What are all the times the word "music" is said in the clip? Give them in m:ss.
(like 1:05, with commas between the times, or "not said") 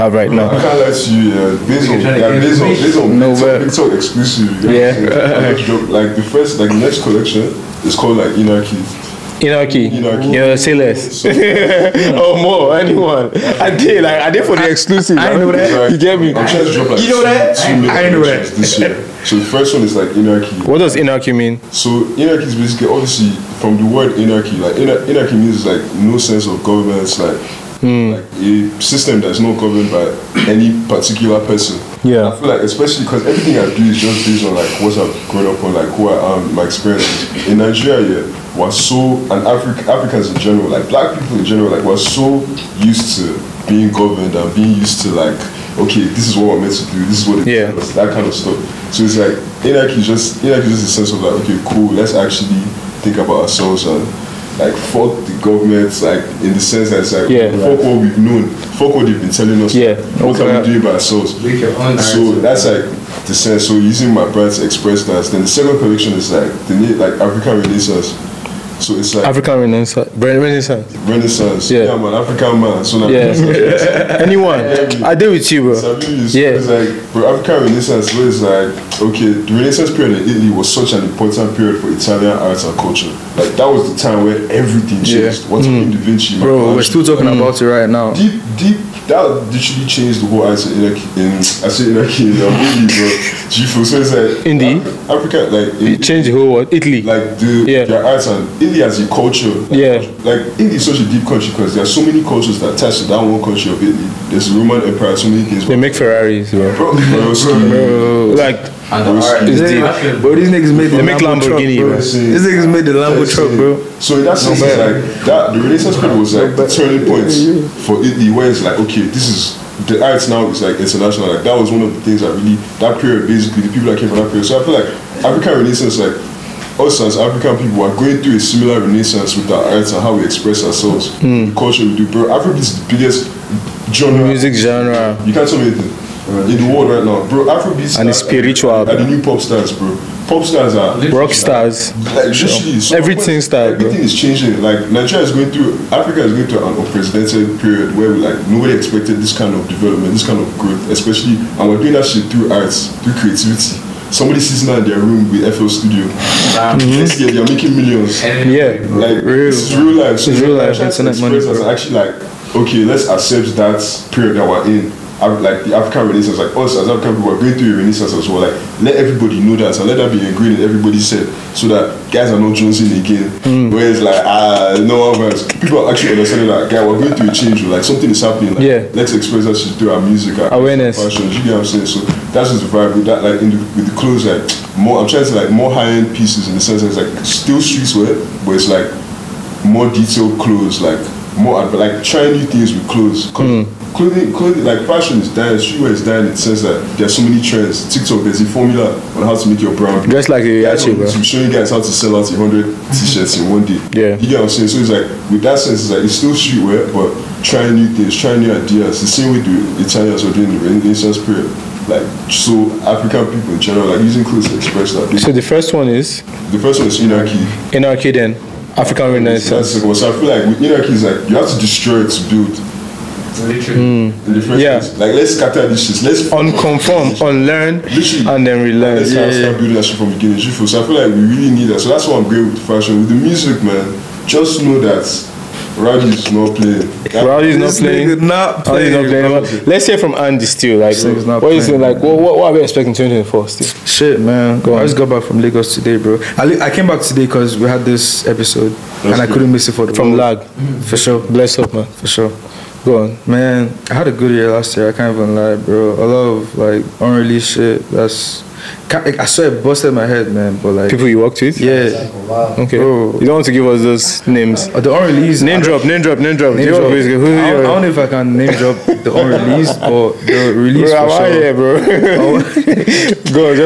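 2:14, 3:00, 3:53.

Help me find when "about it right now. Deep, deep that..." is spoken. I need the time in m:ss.
1:27.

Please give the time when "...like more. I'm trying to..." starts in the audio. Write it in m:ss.
3:04.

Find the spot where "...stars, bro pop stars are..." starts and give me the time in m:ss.
2:19.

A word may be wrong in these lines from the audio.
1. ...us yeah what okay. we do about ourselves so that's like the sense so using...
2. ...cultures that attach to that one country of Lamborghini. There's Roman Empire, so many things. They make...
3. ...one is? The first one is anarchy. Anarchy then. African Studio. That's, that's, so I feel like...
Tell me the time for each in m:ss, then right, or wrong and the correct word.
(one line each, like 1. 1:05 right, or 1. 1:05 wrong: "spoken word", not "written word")
1. 0:59 right
2. 1:42 wrong: "Italy", not "Lamborghini"
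3. 3:35 wrong: "Renaissance", not "Studio".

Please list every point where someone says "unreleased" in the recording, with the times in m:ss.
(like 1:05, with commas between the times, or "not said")
4:17, 4:24, 4:29.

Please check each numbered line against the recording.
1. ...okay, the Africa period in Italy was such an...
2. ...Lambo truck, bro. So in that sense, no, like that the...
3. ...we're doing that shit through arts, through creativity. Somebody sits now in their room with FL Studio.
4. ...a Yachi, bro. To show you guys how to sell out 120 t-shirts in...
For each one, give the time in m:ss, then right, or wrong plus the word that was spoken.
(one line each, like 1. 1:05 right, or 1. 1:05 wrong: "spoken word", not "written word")
1. 1:19 wrong: "Renaissance", not "Africa"
2. 1:52 right
3. 2:31 right
4. 3:20 wrong: "100", not "120".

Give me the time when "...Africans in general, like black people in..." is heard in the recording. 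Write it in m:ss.
0:39.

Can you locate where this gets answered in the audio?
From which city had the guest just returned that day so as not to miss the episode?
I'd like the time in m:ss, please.
4:05.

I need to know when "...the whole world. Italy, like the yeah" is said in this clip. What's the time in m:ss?
1:36.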